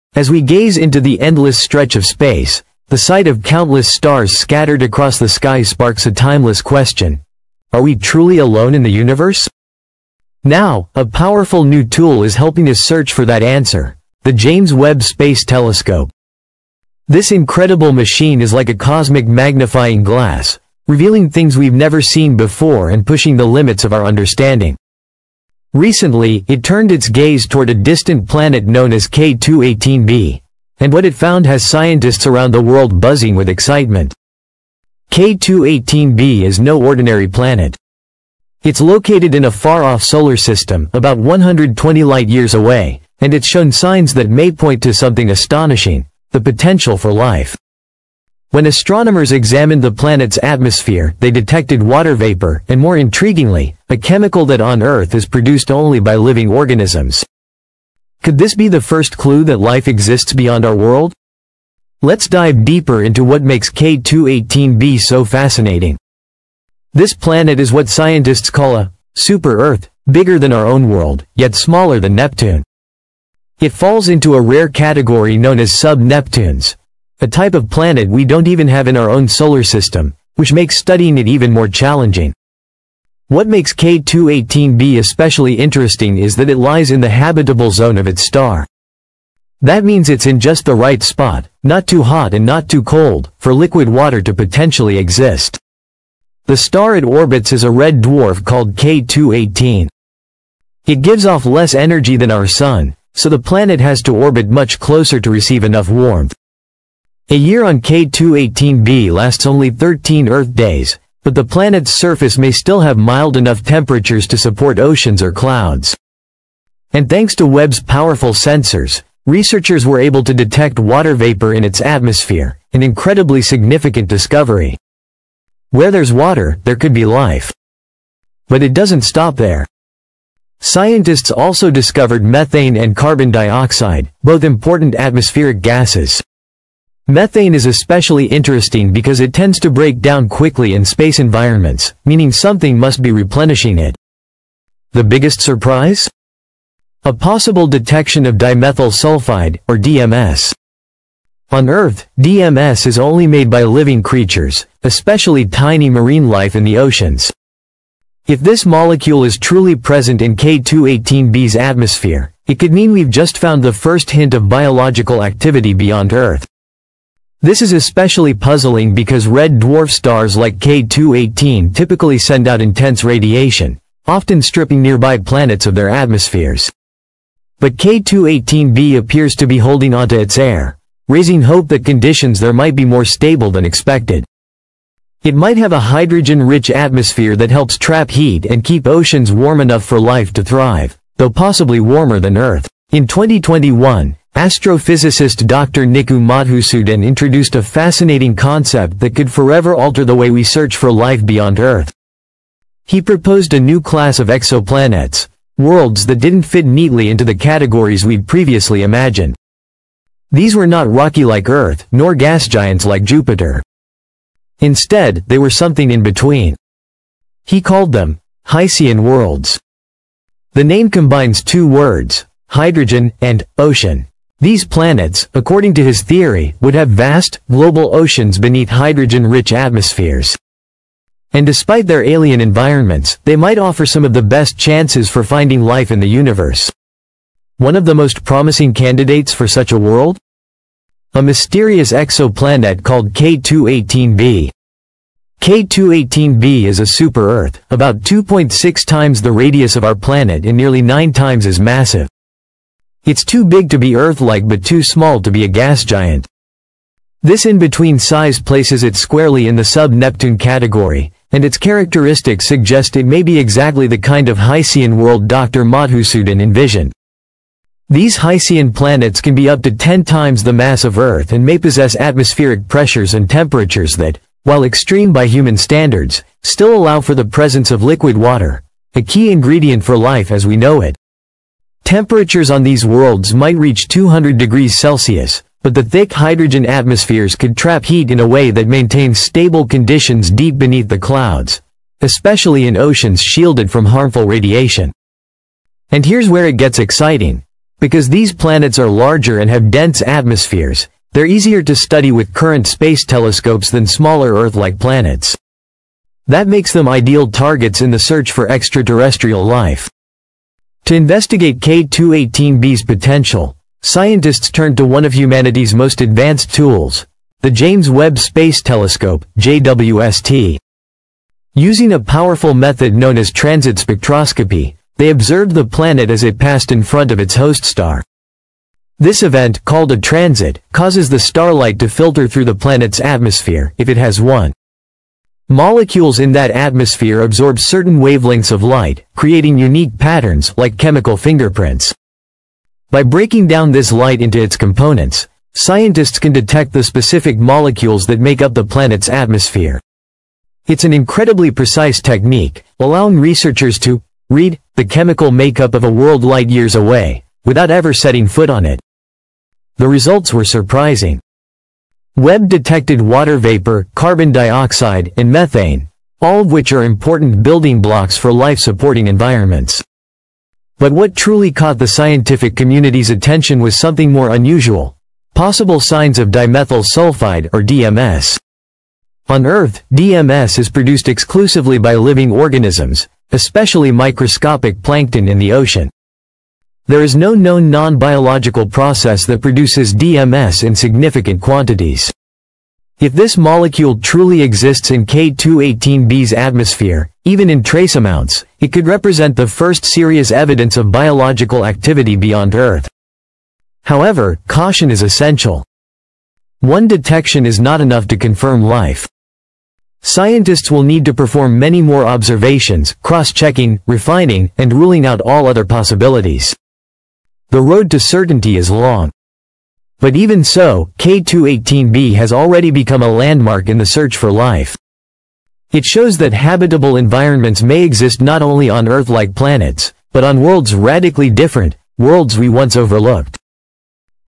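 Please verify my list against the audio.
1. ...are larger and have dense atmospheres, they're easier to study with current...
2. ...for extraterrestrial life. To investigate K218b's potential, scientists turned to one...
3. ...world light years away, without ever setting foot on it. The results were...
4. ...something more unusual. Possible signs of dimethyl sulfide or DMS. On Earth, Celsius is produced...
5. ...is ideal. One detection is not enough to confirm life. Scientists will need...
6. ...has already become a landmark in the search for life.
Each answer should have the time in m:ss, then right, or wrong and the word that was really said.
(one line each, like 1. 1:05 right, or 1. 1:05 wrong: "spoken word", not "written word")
1. 4:58 right
2. 5:08 right
3. 5:55 right
4. 6:13 wrong: "DMS", not "Celsius"
5. 6:44 wrong: "essential", not "ideal"
6. 7:02 right.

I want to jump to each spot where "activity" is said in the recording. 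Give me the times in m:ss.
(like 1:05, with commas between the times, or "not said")
2:45, 6:41.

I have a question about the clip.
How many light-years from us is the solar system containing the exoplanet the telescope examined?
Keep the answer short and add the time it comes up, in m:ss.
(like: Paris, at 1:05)
120 light-years, at 0:40.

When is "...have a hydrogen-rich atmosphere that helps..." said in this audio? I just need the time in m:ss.
3:05.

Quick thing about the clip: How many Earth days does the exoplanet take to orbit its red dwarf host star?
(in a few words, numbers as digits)
13.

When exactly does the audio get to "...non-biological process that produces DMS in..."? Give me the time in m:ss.
6:27.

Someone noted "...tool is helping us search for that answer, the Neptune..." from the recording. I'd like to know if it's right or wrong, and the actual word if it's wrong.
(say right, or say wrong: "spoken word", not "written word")
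wrong: "James", not "Neptune".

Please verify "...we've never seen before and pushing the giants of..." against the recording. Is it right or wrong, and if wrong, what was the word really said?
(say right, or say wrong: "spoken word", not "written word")
wrong: "limits", not "giants".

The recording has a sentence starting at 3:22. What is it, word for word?
He proposed a new class of exoplanets, worlds that didn't fit neatly into the categories we'd previously imagined.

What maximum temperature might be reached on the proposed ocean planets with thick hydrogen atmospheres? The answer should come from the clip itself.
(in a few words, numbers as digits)
200 degrees Celsius.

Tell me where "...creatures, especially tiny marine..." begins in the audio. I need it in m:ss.
2:34.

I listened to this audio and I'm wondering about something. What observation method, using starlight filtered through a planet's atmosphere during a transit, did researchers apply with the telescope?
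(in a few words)
transit spectroscopy.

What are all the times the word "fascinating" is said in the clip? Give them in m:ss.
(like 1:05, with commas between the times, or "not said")
1:05, 3:17.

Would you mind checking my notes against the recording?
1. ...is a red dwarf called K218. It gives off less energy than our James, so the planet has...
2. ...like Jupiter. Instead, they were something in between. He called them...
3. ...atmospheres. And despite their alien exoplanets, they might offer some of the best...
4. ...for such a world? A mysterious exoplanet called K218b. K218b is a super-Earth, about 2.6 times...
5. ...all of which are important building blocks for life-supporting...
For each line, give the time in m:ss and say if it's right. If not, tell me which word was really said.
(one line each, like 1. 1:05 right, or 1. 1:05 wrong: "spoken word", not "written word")
1. 1:37 wrong: "Sun", not "James"
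2. 3:32 right
3. 3:49 wrong: "environments", not "exoplanets"
4. 3:59 right
5. 6:06 right.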